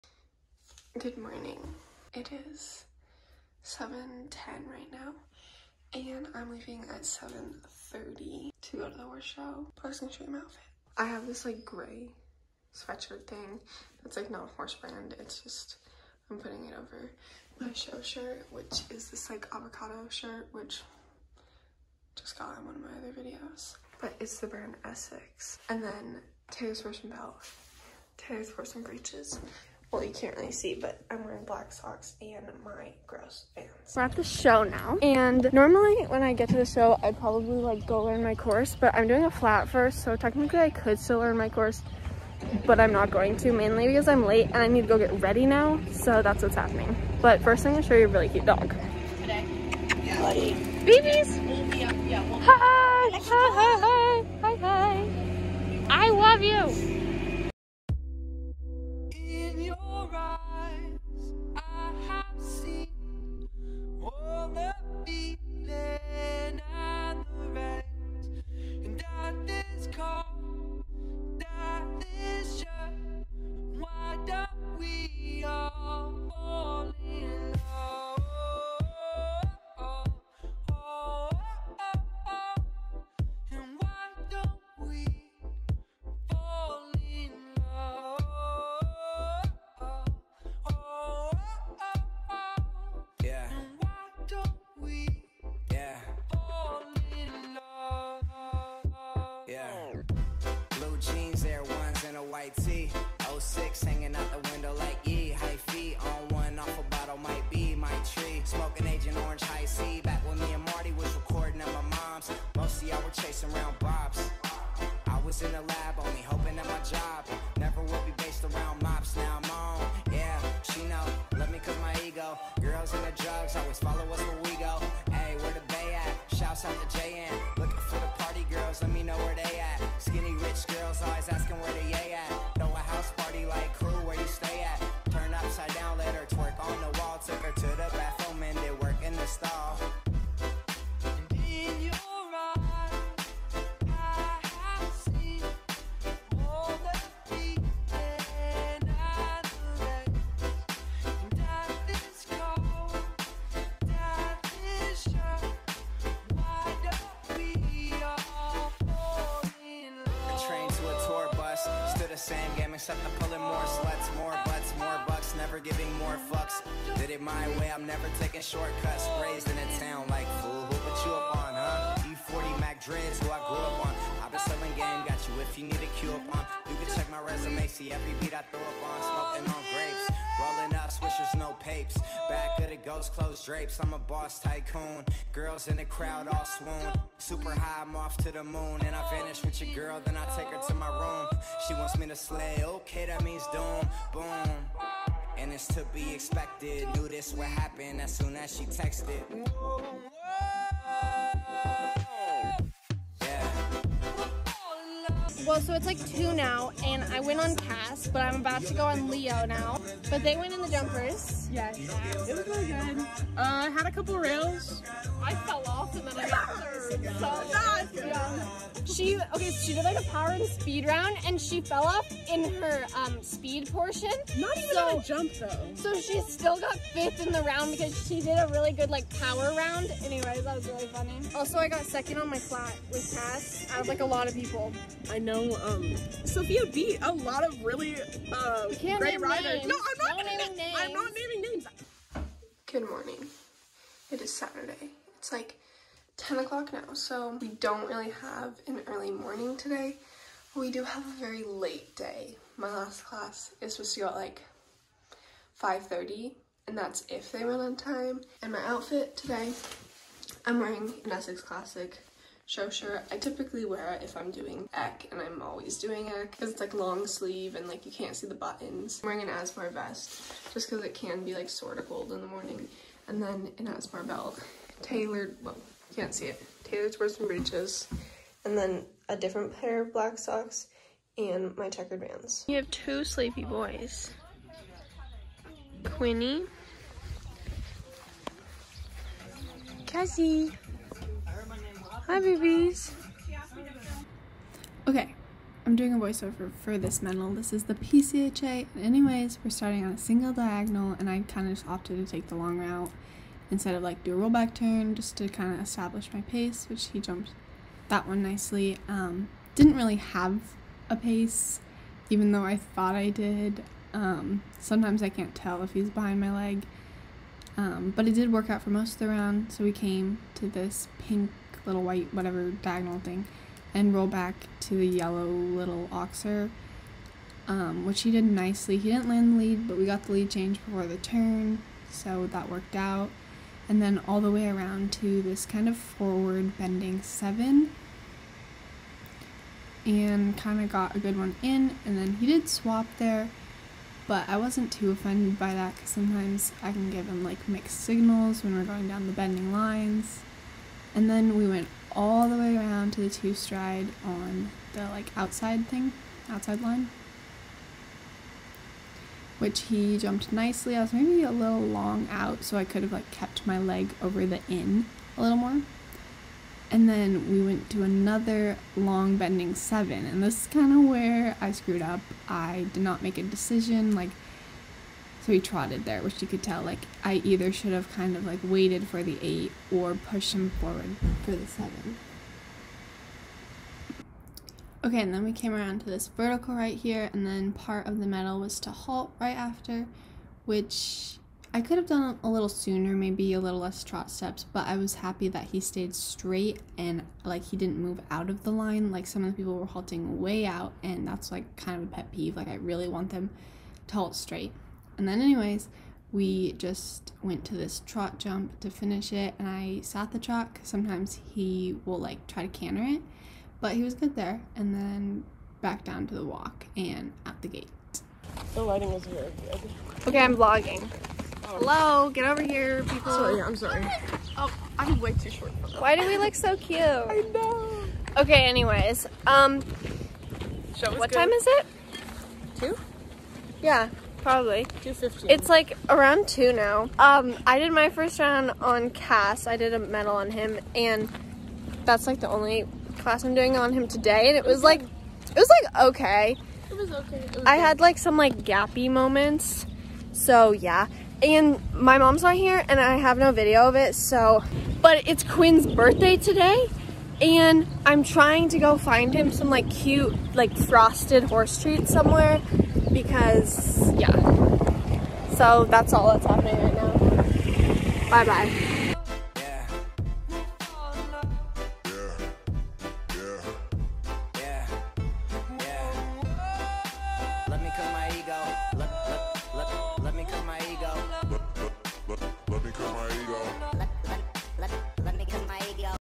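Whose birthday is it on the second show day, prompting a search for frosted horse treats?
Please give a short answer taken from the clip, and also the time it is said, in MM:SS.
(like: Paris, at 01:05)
Quinn, at 07:35.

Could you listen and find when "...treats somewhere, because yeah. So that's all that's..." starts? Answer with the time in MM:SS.
07:41.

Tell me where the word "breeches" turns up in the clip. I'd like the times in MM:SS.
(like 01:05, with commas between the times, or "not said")
00:28, 04:37.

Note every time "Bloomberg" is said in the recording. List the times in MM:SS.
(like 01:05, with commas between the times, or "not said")
not said.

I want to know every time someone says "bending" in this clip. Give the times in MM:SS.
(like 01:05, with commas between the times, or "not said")
05:36, 05:49, 06:09.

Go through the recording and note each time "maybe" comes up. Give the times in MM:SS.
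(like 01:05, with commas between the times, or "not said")
06:00, 06:32.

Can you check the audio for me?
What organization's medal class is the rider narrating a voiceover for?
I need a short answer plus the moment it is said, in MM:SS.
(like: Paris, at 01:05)
PCHA, at 04:57.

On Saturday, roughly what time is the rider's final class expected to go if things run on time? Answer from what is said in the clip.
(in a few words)
5:30.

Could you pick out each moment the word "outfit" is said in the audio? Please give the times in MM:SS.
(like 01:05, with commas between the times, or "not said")
00:10, 04:18.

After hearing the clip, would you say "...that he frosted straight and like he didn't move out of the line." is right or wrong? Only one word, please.
wrong.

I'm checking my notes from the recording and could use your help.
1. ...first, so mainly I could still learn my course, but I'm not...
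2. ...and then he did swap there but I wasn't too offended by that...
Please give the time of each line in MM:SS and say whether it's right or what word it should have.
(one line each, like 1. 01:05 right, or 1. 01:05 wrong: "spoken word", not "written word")
1. 00:39 wrong: "technically", not "mainly"
2. 05:41 right.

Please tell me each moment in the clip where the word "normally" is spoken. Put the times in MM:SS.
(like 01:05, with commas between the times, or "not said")
00:35.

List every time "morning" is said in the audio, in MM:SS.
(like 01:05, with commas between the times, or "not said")
00:01, 04:02, 04:09, 04:32.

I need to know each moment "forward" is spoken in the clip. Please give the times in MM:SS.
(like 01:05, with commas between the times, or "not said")
05:35, 06:20.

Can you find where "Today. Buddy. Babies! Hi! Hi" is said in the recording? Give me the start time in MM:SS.
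00:49.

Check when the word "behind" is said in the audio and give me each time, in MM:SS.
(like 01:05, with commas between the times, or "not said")
05:15.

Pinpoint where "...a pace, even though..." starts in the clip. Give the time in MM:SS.
05:10.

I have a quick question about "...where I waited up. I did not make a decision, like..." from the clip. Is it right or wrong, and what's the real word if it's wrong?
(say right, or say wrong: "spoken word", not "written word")
wrong: "screwed", not "waited".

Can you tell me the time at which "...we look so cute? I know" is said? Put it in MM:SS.
07:06.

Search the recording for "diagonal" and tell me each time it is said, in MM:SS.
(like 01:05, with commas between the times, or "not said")
05:00, 05:22.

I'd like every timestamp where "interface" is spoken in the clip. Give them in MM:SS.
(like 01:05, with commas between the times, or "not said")
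not said.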